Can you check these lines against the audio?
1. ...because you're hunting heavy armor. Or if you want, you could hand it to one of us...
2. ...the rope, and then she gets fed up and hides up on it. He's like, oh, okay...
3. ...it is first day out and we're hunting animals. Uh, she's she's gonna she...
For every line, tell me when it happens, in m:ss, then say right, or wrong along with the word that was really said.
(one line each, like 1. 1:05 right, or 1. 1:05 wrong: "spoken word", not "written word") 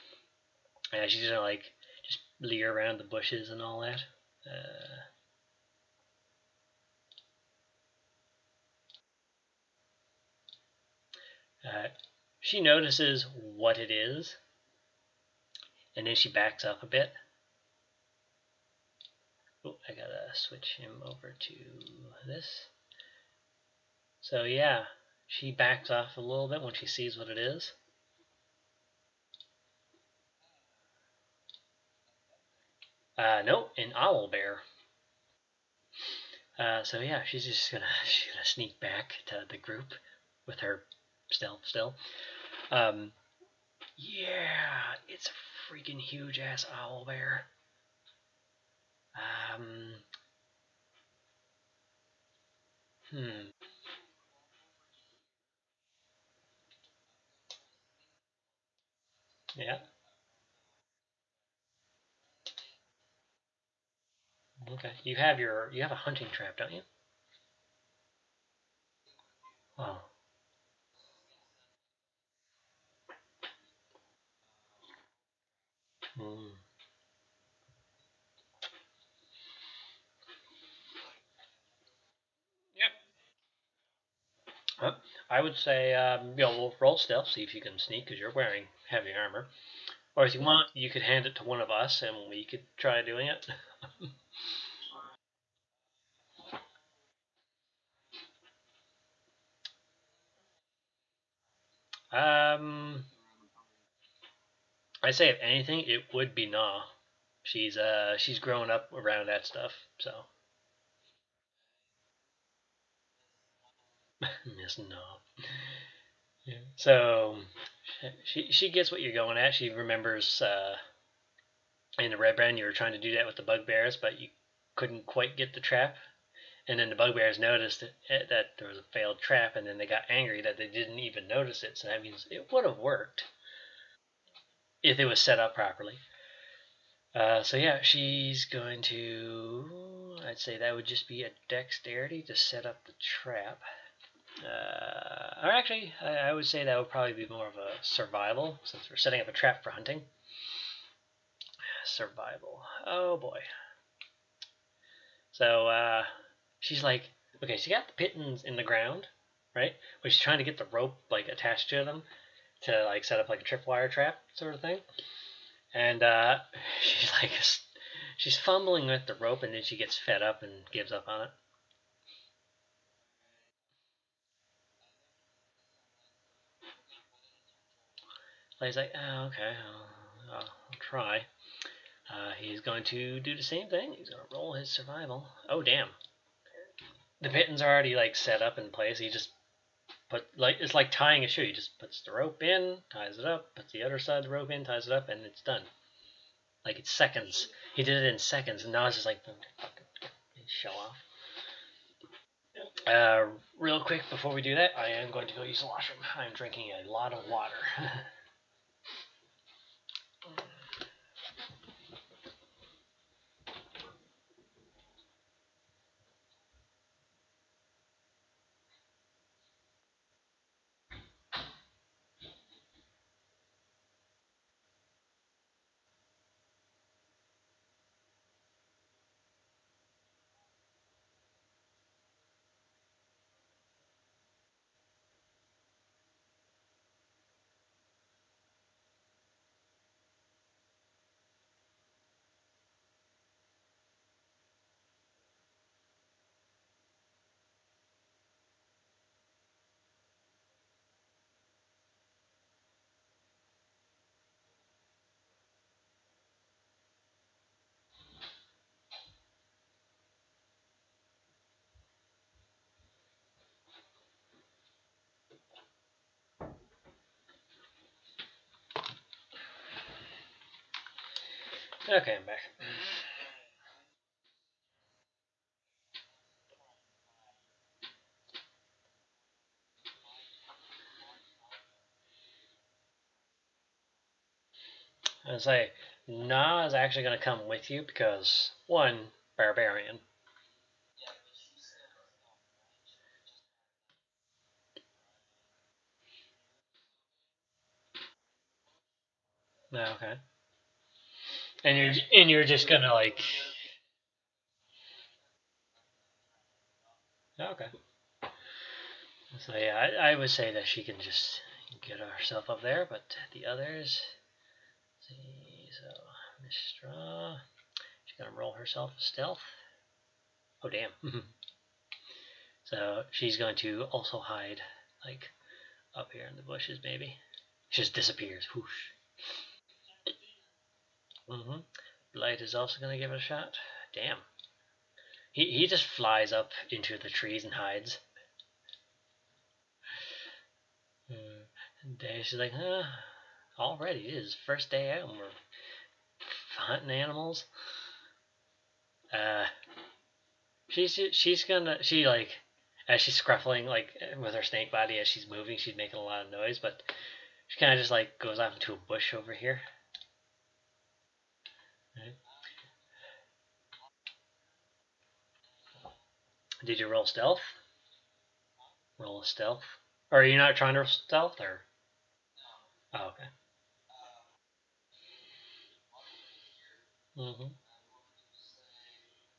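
1. 1:28 wrong: "wearing", not "hunting"
2. 2:49 wrong: "gives", not "hides"
3. 5:44 right.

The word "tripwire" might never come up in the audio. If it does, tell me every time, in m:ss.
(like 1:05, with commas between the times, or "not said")
2:43.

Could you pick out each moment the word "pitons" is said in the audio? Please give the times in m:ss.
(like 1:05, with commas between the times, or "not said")
2:38, 3:07.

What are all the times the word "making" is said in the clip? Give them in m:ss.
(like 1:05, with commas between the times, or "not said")
5:55.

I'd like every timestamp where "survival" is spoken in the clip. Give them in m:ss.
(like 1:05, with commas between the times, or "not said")
2:27, 2:31, 3:04.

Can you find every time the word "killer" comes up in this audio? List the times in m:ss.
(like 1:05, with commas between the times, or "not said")
not said.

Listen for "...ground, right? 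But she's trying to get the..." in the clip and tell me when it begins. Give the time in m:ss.
2:38.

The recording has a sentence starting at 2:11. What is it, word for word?
So that means it would have worked if it was set up properly.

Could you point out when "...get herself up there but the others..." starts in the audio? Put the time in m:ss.
5:11.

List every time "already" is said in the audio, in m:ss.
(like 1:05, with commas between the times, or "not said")
3:07, 5:43.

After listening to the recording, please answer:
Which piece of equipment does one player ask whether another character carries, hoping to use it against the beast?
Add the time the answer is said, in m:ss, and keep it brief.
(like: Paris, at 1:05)
Hunting trap, at 1:05.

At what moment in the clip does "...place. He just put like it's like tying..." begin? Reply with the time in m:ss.
3:08.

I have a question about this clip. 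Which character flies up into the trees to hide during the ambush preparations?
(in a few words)
Blight.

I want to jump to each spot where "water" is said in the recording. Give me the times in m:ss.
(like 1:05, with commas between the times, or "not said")
3:27.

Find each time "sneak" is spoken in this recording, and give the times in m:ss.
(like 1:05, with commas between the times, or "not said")
0:38, 1:27.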